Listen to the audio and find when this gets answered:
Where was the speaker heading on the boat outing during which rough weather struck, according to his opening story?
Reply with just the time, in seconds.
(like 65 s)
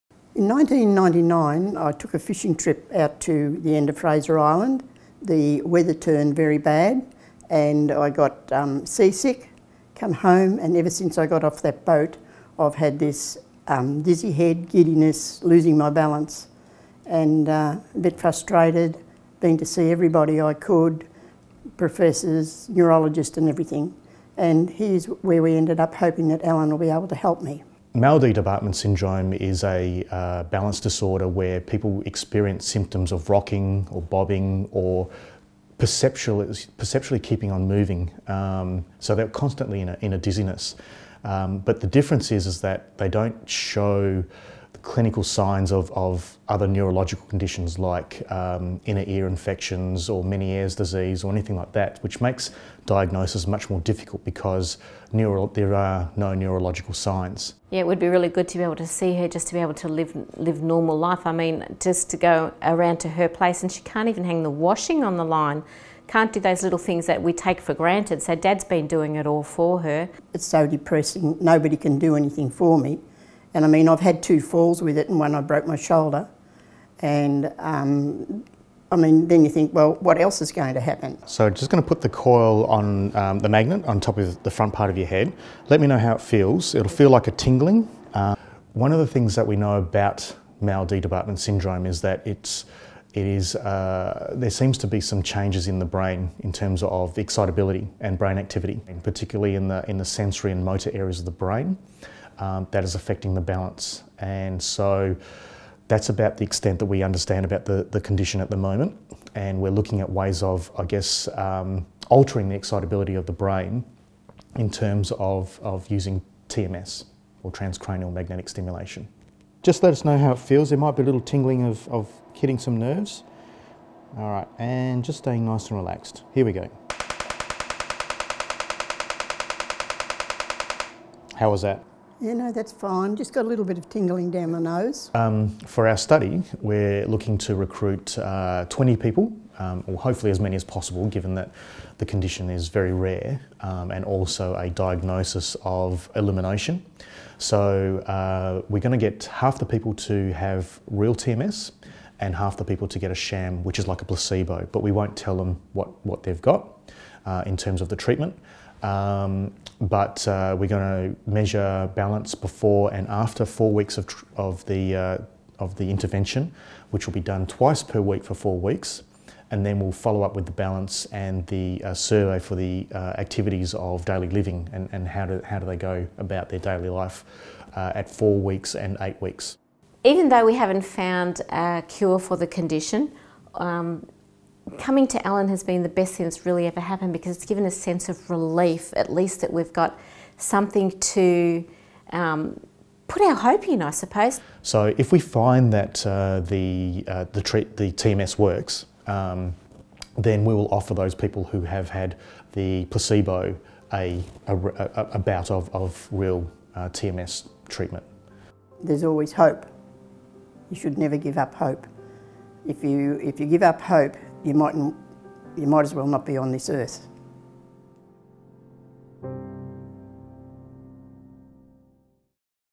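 3 s.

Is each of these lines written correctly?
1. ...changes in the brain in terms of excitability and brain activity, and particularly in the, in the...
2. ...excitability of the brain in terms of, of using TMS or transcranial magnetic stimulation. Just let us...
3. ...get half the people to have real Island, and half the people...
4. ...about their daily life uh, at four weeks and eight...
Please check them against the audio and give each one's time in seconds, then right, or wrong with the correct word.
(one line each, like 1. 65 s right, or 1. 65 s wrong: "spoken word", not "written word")
1. 95 s right
2. 112 s right
3. 149 s wrong: "TMS", not "Island"
4. 176 s right.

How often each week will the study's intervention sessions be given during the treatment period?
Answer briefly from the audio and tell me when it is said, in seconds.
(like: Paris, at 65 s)
twice per week, at 167 s.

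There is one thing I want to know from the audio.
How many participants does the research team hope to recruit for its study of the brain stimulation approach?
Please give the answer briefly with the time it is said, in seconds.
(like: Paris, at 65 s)
20, at 138 s.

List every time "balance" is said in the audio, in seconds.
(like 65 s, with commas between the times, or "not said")
15 s, 30 s, 103 s, 161 s, 170 s.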